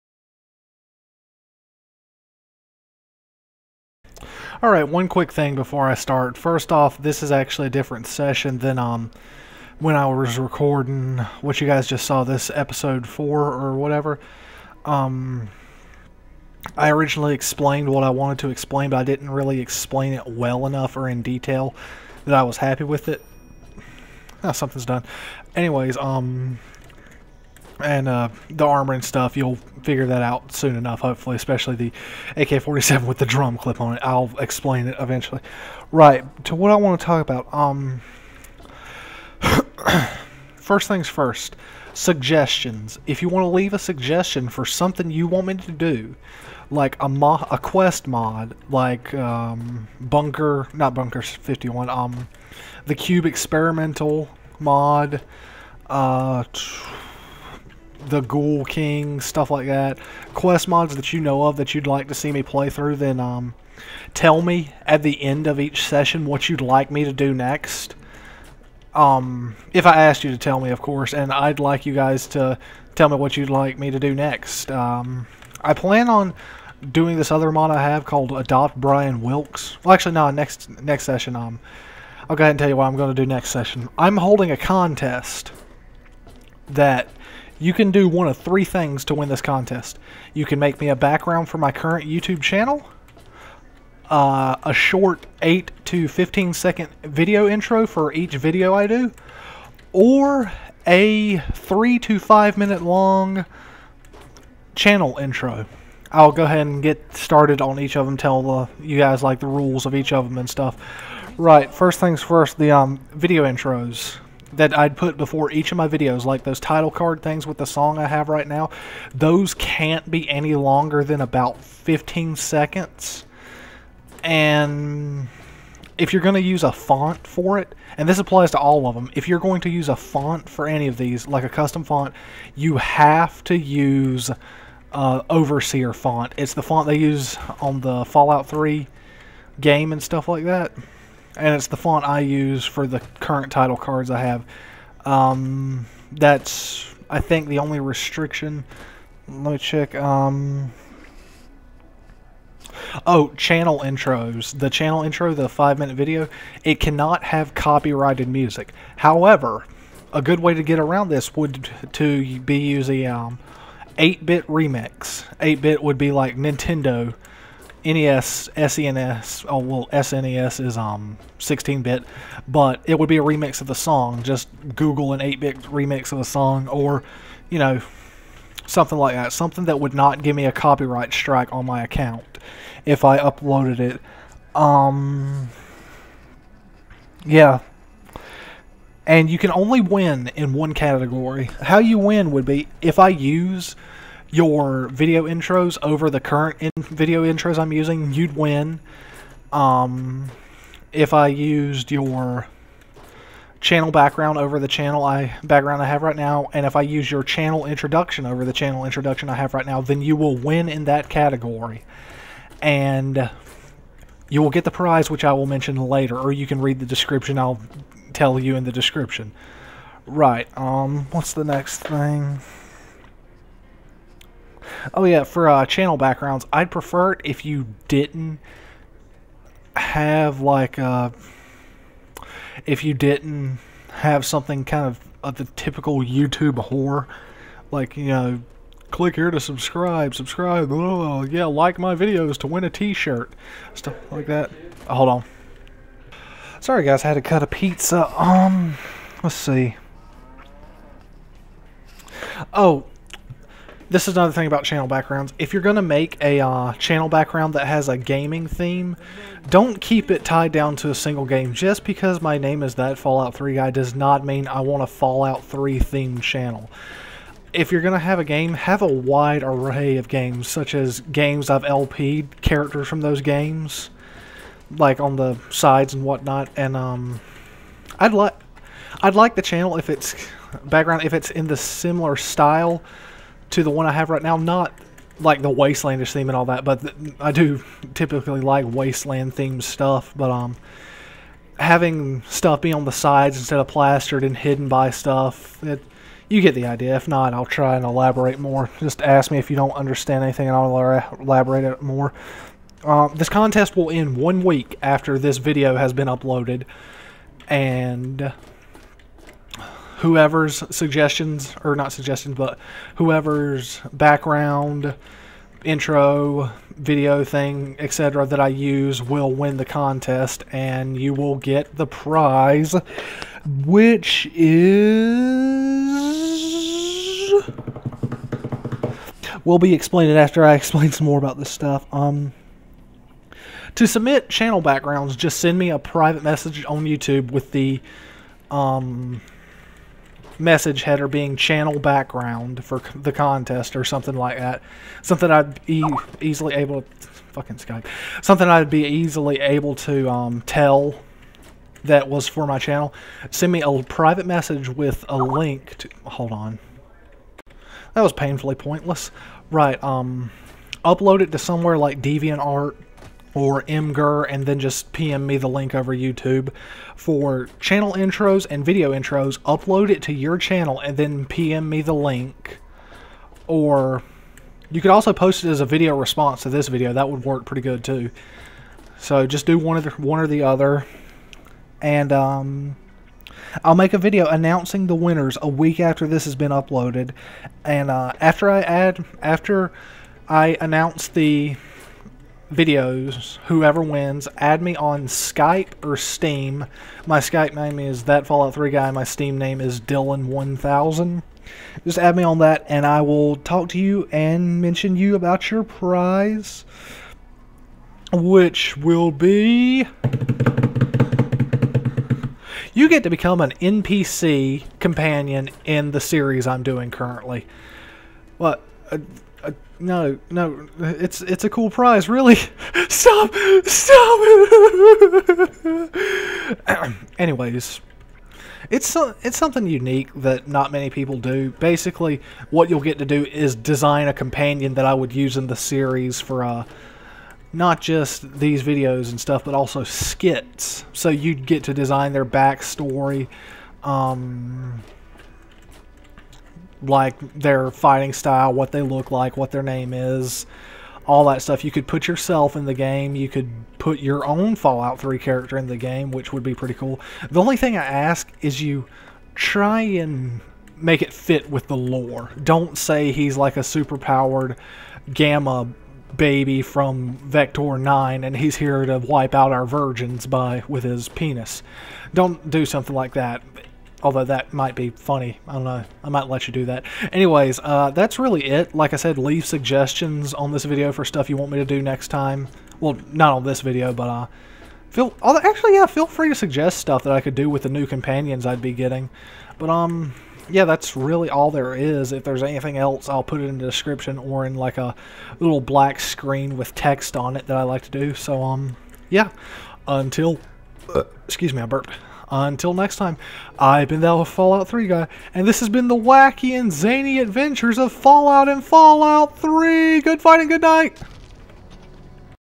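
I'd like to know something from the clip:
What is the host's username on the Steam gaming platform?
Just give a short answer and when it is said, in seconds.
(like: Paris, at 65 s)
Dylan1000, at 399 s.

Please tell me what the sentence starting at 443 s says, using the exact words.
Um, like their fighting style, what they look like, what their name is, all that stuff.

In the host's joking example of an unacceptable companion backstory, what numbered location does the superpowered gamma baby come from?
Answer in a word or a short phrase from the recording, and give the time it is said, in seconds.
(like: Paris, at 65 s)
Vector 9, at 467 s.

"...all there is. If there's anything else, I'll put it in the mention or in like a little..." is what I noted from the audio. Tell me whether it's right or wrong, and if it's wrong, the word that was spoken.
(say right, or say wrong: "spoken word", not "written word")
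wrong: "description", not "mention".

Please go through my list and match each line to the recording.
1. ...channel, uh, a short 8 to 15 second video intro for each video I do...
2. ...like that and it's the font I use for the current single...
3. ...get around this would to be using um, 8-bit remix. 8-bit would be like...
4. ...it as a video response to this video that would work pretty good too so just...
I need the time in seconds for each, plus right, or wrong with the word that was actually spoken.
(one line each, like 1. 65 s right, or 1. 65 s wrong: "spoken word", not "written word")
1. 92 s right
2. 140 s wrong: "title", not "single"
3. 160 s right
4. 375 s right.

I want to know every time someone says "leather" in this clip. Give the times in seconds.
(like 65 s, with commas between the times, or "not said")
not said.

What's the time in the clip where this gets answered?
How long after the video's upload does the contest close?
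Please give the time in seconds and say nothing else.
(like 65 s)
304 s.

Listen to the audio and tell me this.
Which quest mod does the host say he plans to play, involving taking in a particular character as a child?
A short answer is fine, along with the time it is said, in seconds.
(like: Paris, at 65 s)
Adopt Brian Wilks, at 78 s.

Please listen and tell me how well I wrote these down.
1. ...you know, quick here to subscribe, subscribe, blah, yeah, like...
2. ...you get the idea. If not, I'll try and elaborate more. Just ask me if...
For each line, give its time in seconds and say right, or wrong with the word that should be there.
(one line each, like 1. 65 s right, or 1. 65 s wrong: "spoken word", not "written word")
1. 237 s wrong: "click", not "quick"
2. 296 s right.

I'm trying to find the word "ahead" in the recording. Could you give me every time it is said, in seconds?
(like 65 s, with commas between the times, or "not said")
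82 s, 106 s.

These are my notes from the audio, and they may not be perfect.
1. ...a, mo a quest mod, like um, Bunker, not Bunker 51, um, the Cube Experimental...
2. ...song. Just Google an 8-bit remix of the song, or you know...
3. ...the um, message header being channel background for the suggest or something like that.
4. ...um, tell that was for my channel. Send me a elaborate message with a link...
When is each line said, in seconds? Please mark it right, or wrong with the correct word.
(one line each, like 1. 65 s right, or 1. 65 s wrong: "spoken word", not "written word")
1. 47 s right
2. 173 s right
3. 337 s wrong: "contest", not "suggest"
4. 350 s wrong: "private", not "elaborate".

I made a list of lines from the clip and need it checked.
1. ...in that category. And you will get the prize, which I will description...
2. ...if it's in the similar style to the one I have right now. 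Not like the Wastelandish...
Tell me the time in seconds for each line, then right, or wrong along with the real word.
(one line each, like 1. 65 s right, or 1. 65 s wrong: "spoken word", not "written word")
1. 210 s wrong: "mention", not "description"
2. 281 s right.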